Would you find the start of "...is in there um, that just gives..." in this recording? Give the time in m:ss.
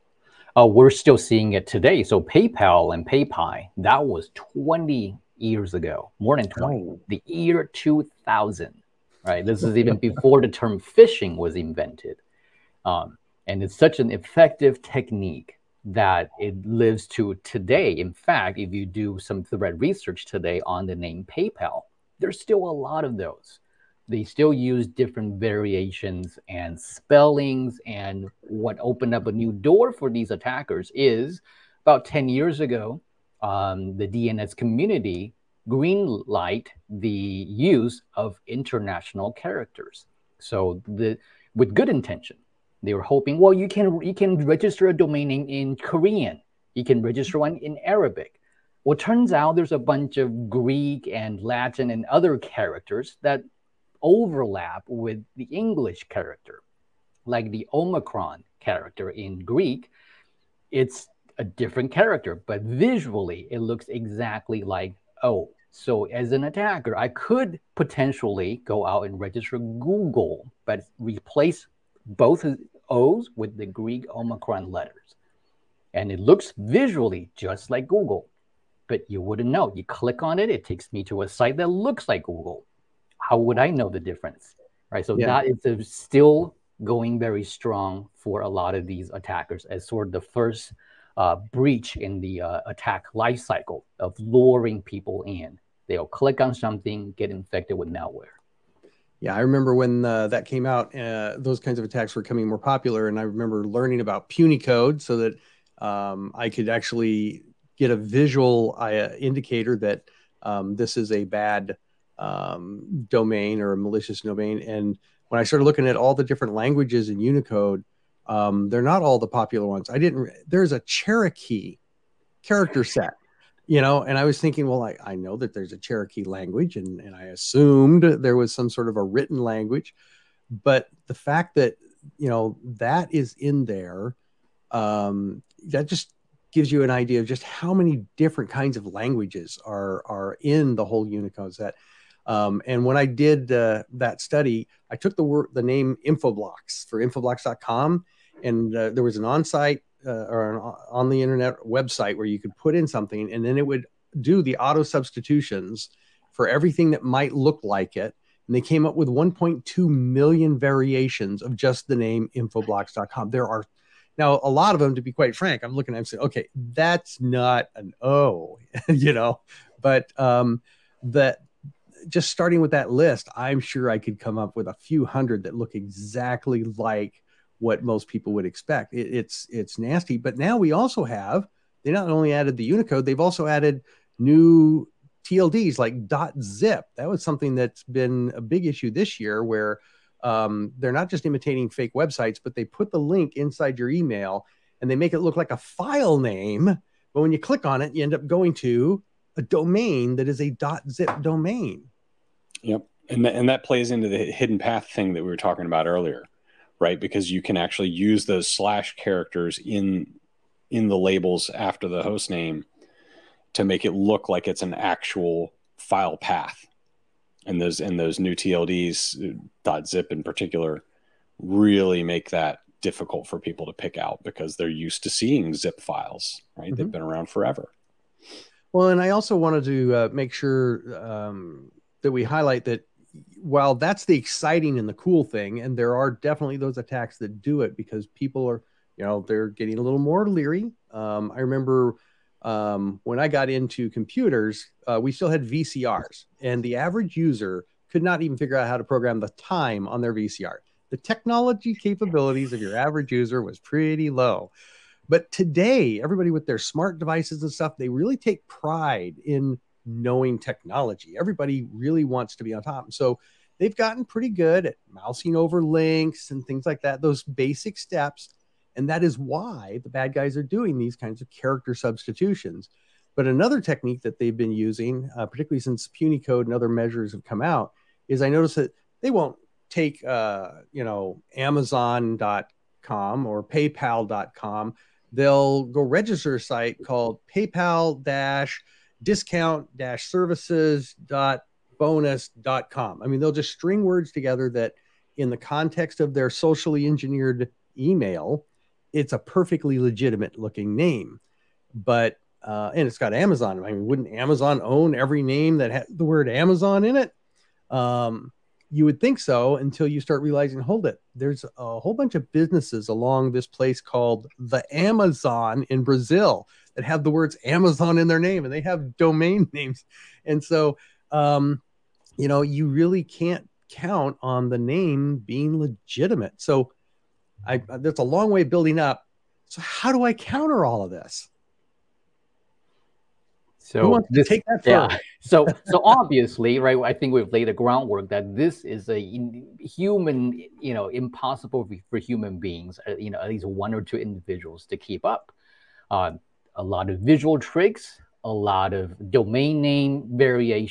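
2:13.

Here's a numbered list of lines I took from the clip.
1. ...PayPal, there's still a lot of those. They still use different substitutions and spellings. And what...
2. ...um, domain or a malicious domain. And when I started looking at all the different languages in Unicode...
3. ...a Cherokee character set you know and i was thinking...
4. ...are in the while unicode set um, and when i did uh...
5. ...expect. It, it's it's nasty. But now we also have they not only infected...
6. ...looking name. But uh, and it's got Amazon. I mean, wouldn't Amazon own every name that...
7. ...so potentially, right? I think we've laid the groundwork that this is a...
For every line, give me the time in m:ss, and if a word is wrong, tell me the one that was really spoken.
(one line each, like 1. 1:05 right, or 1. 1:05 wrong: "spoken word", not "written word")
1. 0:21 wrong: "variations", not "substitutions"
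2. 1:52 right
3. 2:00 right
4. 2:20 wrong: "whole", not "while"
5. 2:58 wrong: "added", not "infected"
6. 5:00 right
7. 5:35 wrong: "obviously", not "potentially".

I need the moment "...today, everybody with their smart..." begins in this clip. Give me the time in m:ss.
4:15.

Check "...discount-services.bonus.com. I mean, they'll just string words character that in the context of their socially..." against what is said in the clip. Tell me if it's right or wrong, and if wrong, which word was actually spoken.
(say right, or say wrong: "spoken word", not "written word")
wrong: "together", not "character".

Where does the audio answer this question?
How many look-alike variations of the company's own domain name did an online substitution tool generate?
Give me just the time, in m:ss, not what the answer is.
2:39.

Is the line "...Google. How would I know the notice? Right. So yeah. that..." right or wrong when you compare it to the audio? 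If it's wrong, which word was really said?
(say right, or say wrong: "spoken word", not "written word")
wrong: "difference", not "notice".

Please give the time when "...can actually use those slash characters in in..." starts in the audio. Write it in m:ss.
3:27.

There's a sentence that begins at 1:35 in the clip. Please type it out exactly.
They'll click on something, get infected with malware.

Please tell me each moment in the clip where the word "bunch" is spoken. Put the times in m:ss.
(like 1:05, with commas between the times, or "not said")
0:49, 5:11.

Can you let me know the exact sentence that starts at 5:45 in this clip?
Um, a lot of visual tricks, a lot of domain name variations.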